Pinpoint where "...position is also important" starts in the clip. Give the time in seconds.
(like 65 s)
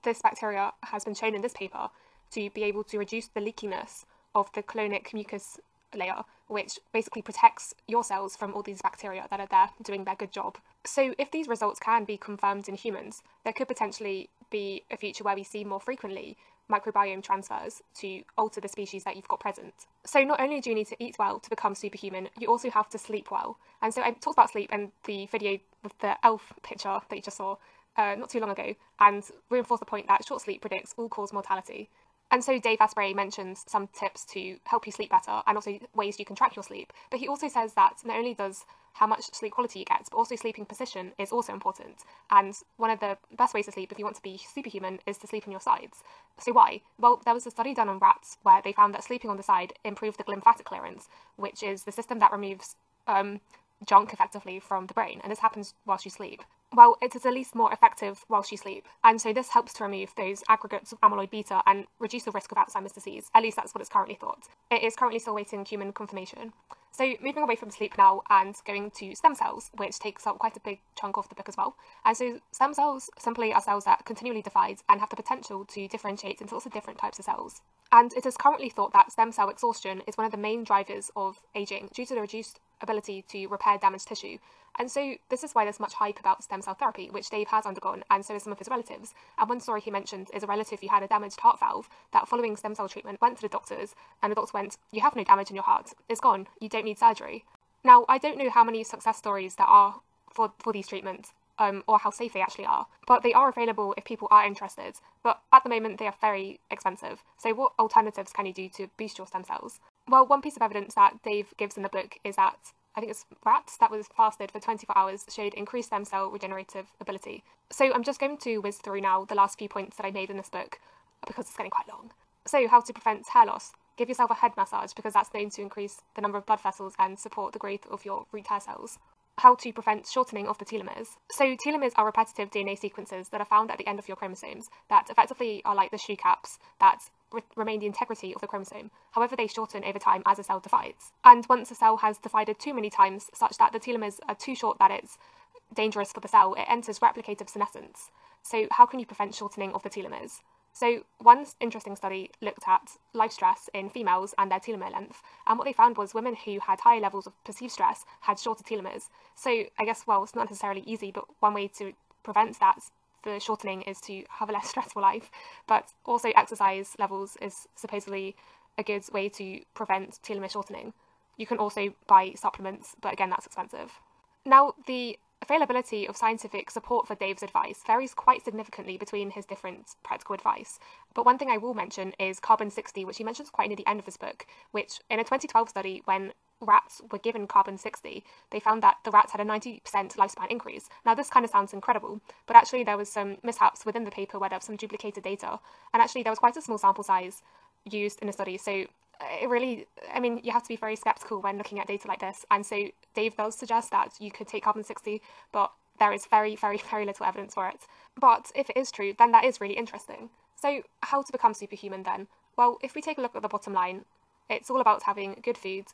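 40 s.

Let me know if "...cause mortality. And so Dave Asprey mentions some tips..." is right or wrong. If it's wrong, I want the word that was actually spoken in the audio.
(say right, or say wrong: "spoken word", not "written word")
right.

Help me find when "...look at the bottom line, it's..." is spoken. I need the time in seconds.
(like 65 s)
213 s.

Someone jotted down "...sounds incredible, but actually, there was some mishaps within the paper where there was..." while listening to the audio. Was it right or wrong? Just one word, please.
right.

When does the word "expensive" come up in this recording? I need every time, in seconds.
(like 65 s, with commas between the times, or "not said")
106 s, 173 s.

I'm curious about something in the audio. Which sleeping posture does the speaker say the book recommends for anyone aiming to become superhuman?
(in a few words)
On your sides.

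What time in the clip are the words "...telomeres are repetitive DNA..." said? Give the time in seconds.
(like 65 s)
131 s.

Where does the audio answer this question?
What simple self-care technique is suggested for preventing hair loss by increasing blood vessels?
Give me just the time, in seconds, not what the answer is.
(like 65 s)
124 s.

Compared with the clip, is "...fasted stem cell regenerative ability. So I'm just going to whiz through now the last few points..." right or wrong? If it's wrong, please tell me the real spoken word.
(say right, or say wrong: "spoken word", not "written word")
wrong: "increased", not "fasted".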